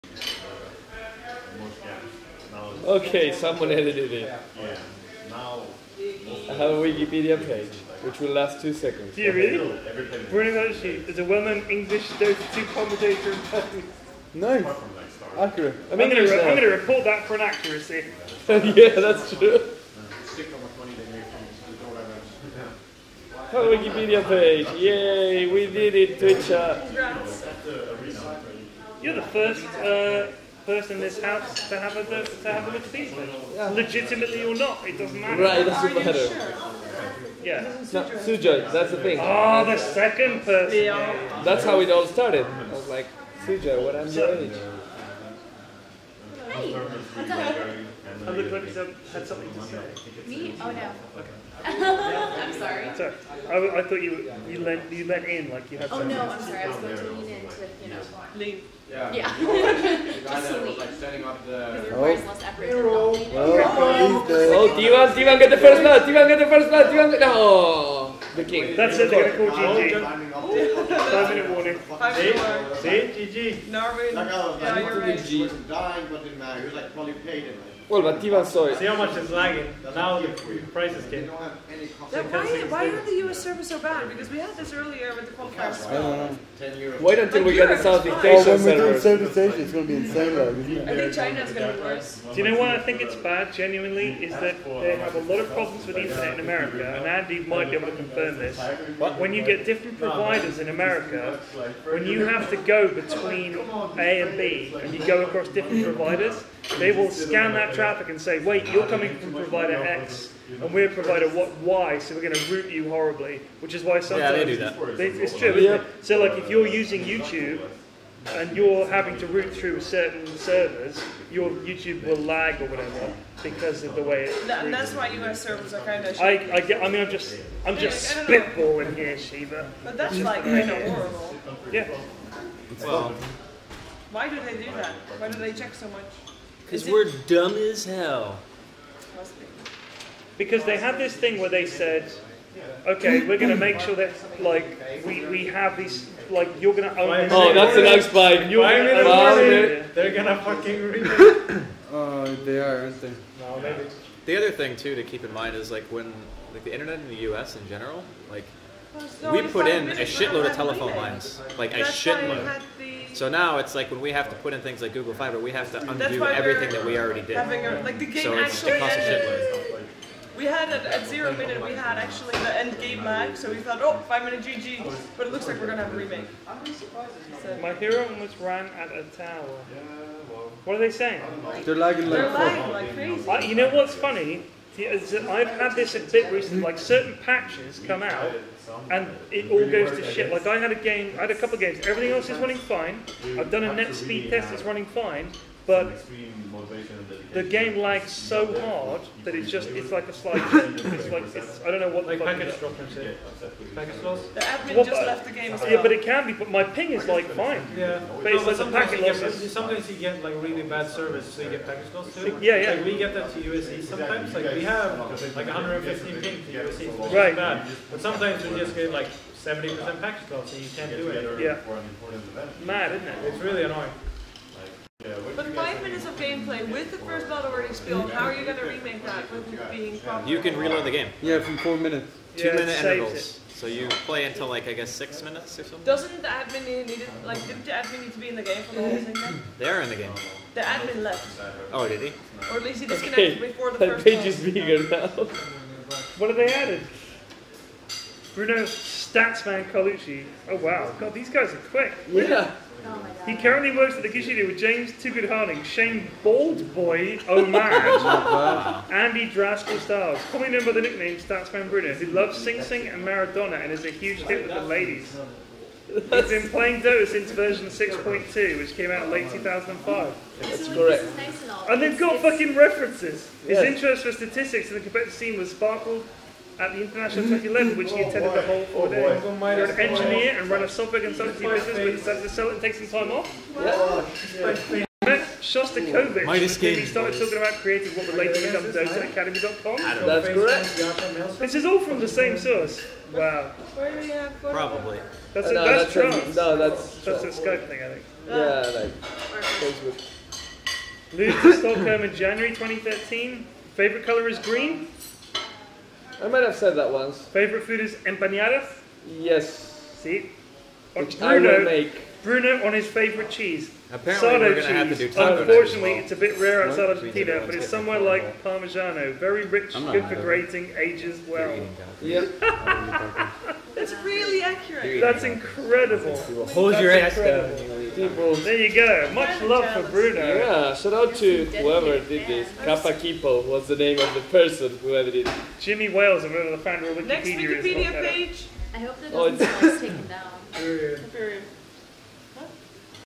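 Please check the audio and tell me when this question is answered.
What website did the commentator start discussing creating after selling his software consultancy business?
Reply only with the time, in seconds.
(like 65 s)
288 s.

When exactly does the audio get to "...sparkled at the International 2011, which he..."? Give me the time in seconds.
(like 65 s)
275 s.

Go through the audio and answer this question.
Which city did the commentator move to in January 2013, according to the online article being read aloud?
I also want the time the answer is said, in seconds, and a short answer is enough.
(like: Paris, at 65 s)
Stockholm, at 301 s.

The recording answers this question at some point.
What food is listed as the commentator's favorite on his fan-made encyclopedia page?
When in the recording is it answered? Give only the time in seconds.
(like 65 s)
308 s.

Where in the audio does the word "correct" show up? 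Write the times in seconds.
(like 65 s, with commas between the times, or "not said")
270 s, 290 s.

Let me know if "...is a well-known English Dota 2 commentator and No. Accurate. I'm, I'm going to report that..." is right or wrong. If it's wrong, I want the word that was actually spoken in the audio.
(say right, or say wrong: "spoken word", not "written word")
right.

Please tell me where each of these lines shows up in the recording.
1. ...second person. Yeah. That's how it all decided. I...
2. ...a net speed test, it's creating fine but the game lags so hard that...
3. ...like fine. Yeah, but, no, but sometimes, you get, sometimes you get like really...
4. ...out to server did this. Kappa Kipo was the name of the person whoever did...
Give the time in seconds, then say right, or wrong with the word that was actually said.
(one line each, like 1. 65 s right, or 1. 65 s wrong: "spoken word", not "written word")
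1. 39 s wrong: "started", not "decided"
2. 193 s wrong: "running", not "creating"
3. 207 s right
4. 330 s wrong: "whoever", not "server".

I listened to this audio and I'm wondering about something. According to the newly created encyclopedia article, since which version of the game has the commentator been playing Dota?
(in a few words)
6.2.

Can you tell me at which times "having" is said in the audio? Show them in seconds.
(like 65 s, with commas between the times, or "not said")
118 s, 167 s.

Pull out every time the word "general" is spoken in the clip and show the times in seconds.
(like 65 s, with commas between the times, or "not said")
157 s.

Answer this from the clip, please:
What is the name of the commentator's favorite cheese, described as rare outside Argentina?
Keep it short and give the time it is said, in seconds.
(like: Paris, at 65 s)
Sardo, at 314 s.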